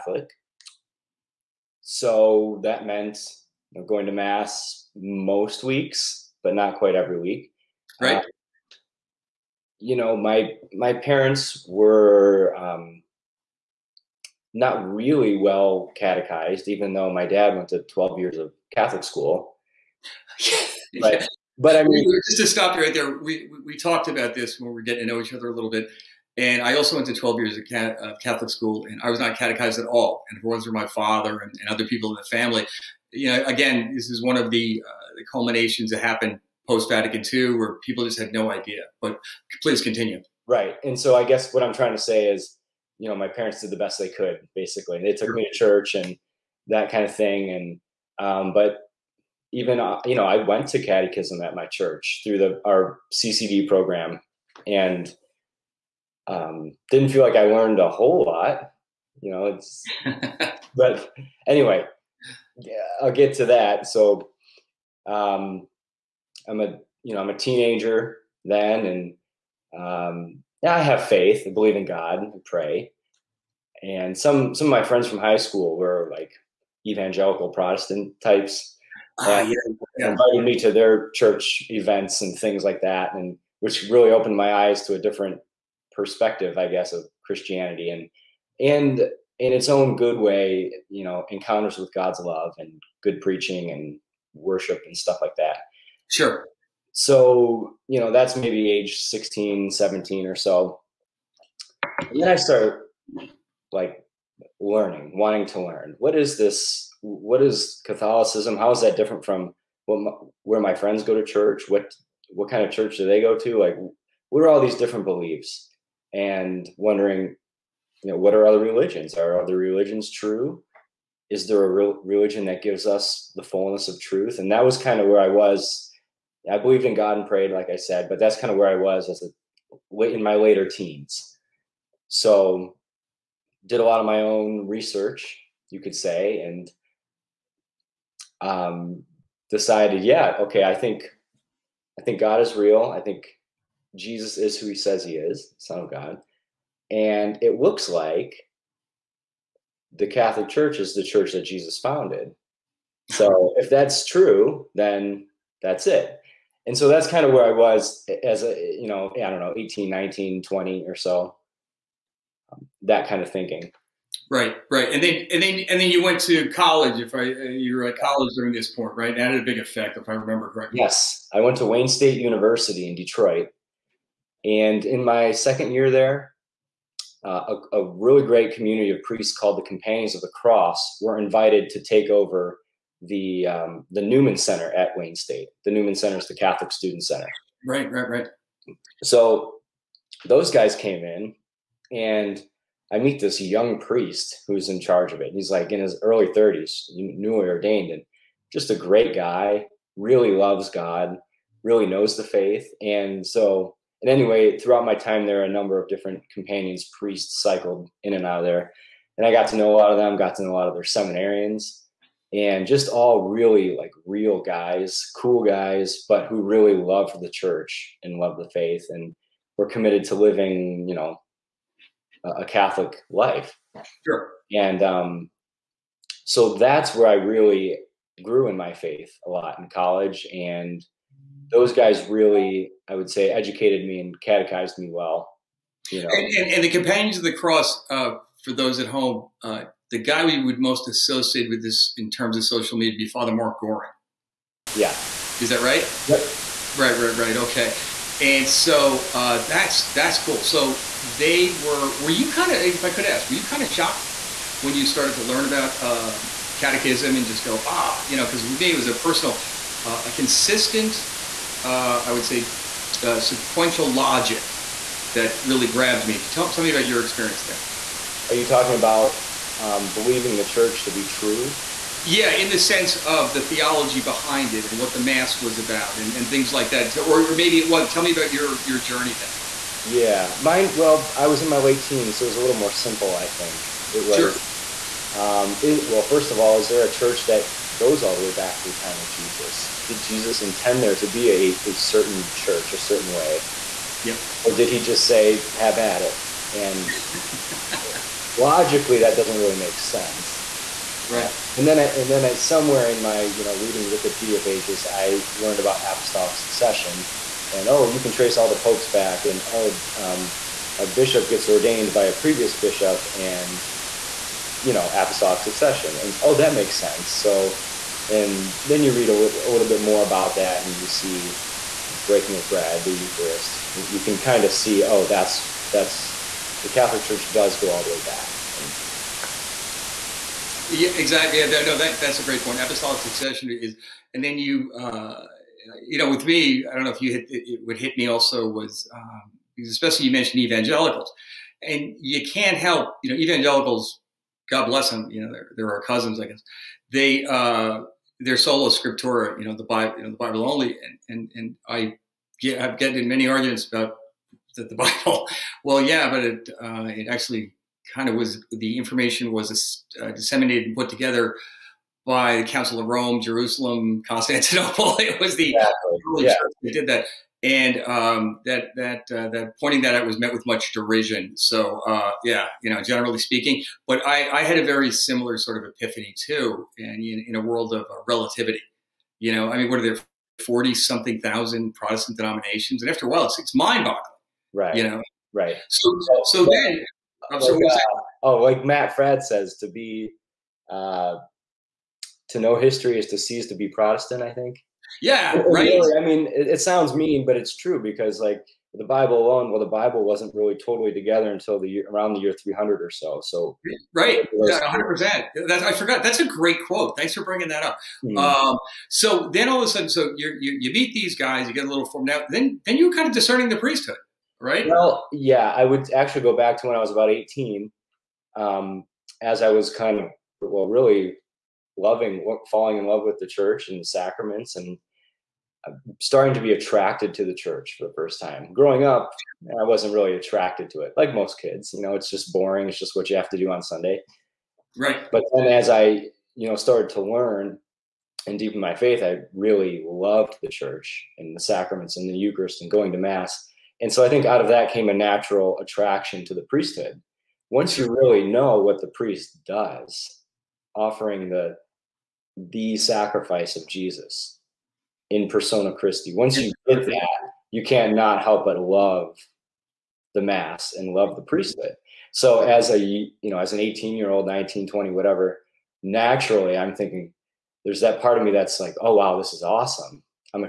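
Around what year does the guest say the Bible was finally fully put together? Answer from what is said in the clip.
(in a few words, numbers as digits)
300.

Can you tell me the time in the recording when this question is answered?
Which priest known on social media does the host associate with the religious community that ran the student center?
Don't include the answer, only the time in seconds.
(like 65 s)
243 s.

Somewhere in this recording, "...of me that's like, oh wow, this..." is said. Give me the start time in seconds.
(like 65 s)
468 s.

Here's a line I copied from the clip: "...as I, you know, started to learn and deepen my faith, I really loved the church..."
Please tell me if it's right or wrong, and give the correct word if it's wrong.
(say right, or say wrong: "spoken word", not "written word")
right.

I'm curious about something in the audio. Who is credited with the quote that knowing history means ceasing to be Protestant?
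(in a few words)
Matt Fradd.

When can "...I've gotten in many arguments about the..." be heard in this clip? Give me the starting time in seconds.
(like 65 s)
352 s.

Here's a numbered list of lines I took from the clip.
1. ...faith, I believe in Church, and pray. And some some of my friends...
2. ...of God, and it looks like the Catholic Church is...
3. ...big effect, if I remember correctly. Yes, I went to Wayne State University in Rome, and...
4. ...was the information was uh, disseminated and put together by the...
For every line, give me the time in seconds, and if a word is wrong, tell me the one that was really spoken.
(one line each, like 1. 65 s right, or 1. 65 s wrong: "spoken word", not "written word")
1. 71 s wrong: "God", not "Church"
2. 145 s right
3. 169 s wrong: "Detroit", not "Rome"
4. 358 s right.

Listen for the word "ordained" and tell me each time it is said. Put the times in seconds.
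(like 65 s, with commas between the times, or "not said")
197 s, 311 s.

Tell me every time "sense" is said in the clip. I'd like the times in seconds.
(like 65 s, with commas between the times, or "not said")
272 s, 299 s, 316 s.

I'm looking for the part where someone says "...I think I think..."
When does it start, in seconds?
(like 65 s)
140 s.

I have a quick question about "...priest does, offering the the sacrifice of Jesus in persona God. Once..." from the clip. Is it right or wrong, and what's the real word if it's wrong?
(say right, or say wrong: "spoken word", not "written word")
wrong: "Christi", not "God".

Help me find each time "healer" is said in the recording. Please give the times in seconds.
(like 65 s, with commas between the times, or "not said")
not said.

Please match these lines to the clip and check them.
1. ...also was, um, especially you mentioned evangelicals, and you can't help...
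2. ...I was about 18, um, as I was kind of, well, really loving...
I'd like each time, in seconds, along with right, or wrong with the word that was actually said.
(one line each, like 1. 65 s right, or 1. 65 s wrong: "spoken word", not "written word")
1. 338 s right
2. 416 s right.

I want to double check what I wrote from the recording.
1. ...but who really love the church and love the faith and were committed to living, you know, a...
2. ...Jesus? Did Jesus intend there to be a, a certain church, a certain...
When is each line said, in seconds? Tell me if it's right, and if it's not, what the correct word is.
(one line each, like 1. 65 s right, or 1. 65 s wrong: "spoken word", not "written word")
1. 216 s right
2. 289 s right.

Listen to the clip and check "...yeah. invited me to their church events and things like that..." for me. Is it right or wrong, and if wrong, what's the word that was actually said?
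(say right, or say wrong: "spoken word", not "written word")
right.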